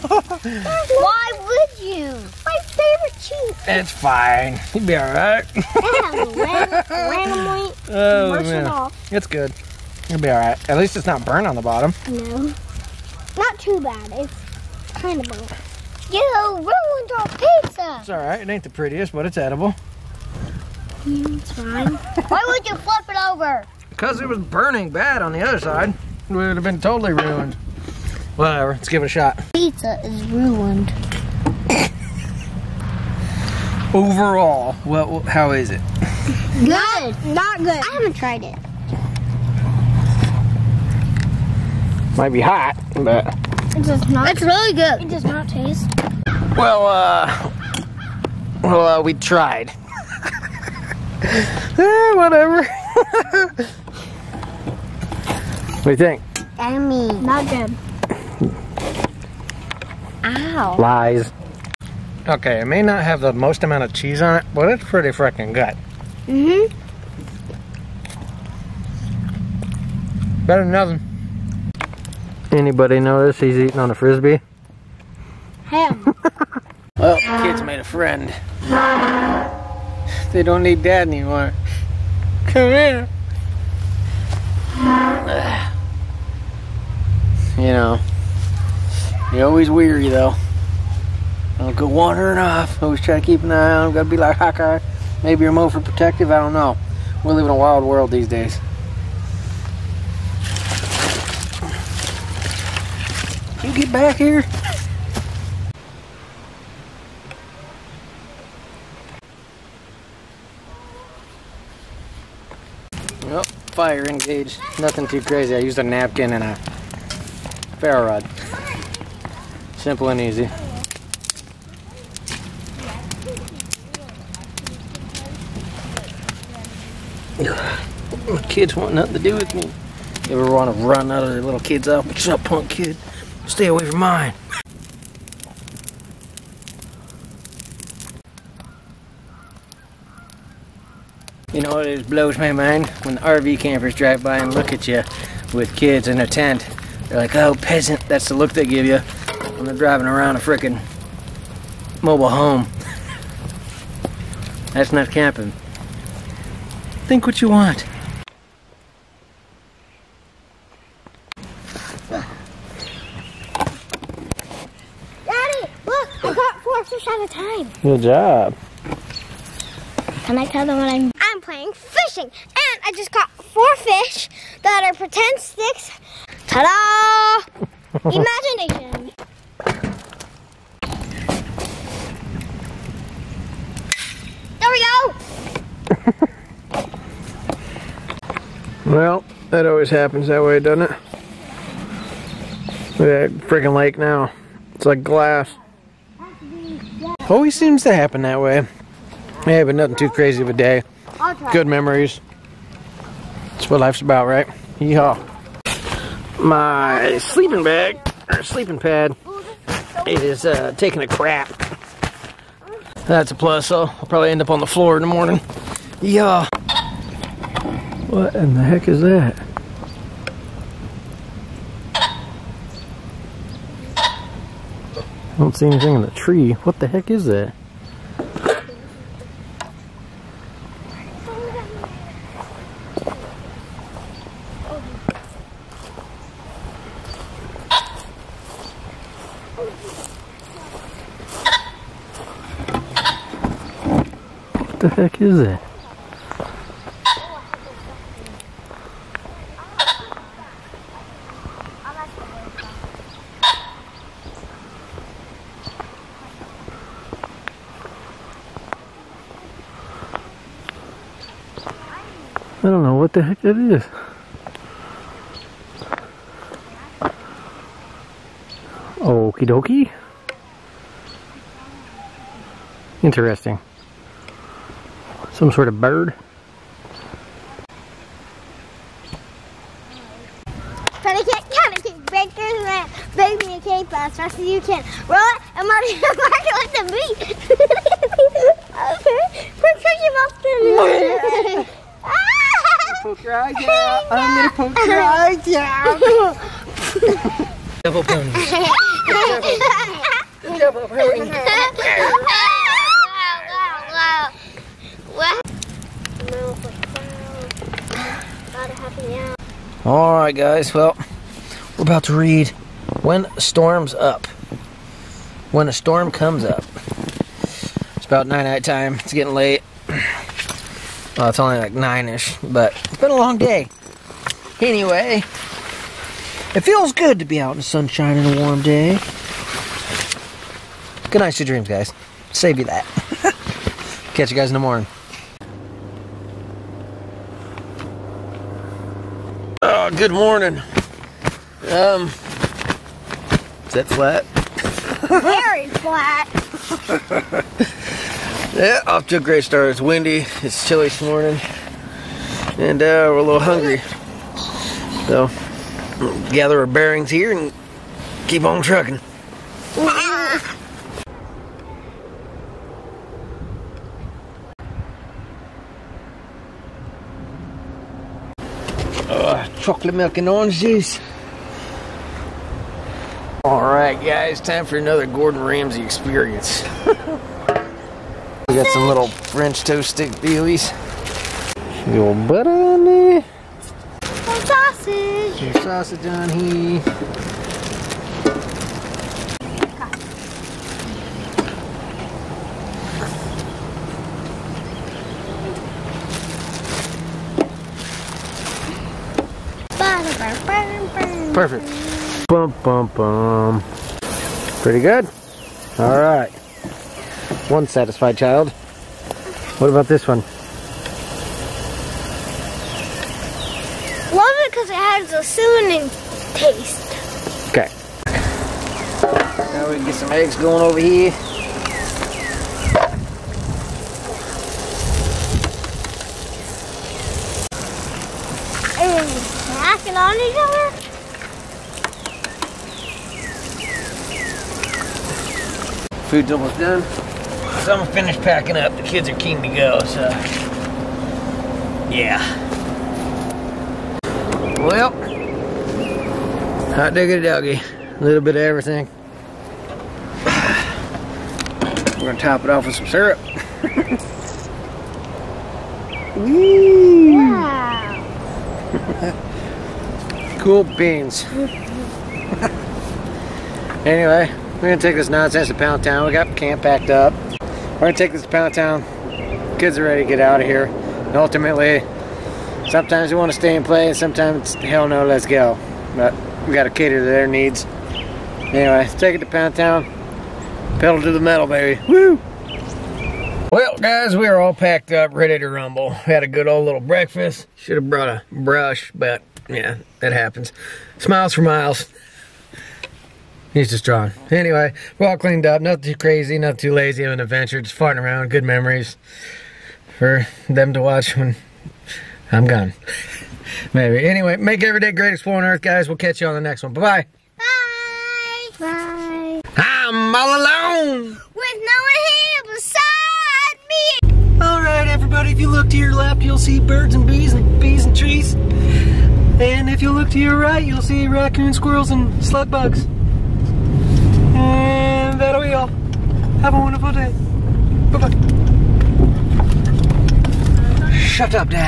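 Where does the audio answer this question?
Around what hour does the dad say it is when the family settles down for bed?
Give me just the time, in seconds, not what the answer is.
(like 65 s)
321 s.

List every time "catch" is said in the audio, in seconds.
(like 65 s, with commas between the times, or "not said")
334 s, 505 s.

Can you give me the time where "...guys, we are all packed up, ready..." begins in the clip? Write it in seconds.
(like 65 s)
483 s.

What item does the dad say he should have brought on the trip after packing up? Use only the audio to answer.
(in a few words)
A brush.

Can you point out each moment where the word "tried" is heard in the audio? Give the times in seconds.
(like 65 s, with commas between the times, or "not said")
38 s, 49 s.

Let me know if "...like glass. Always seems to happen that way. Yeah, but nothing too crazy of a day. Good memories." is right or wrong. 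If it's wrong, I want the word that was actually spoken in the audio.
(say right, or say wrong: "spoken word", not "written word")
right.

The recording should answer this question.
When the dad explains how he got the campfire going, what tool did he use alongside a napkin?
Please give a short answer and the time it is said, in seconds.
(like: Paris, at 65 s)
Ferro rod, at 117 s.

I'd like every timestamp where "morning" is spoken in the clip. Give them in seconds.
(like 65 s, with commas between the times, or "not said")
215 s, 334 s, 340 s, 351 s.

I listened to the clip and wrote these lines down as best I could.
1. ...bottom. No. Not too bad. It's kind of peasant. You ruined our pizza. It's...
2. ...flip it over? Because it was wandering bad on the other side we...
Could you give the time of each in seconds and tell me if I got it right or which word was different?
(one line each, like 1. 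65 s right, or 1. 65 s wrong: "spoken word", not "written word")
1. 11 s wrong: "burnt", not "peasant"
2. 22 s wrong: "burning", not "wandering".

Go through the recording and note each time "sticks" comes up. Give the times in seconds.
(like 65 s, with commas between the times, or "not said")
175 s, 379 s.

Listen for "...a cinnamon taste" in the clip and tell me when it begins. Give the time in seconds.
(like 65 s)
415 s.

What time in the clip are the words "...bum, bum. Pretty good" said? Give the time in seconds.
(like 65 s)
402 s.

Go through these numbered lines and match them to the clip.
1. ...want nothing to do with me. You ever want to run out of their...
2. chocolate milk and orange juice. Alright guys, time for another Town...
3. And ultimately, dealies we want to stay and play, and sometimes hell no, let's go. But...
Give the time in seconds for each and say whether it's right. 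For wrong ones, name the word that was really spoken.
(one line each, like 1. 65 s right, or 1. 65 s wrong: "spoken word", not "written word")
1. 128 s right
2. 369 s wrong: "Gordon", not "Town"
3. 470 s wrong: "sometimes", not "dealies".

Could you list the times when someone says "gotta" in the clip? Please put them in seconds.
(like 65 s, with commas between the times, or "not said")
93 s, 476 s.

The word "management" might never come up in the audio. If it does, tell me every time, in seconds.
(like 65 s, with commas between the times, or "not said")
not said.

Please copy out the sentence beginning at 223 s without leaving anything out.
I don't see anything in the tree.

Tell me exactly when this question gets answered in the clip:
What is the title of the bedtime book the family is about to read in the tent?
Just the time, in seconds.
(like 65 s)
315 s.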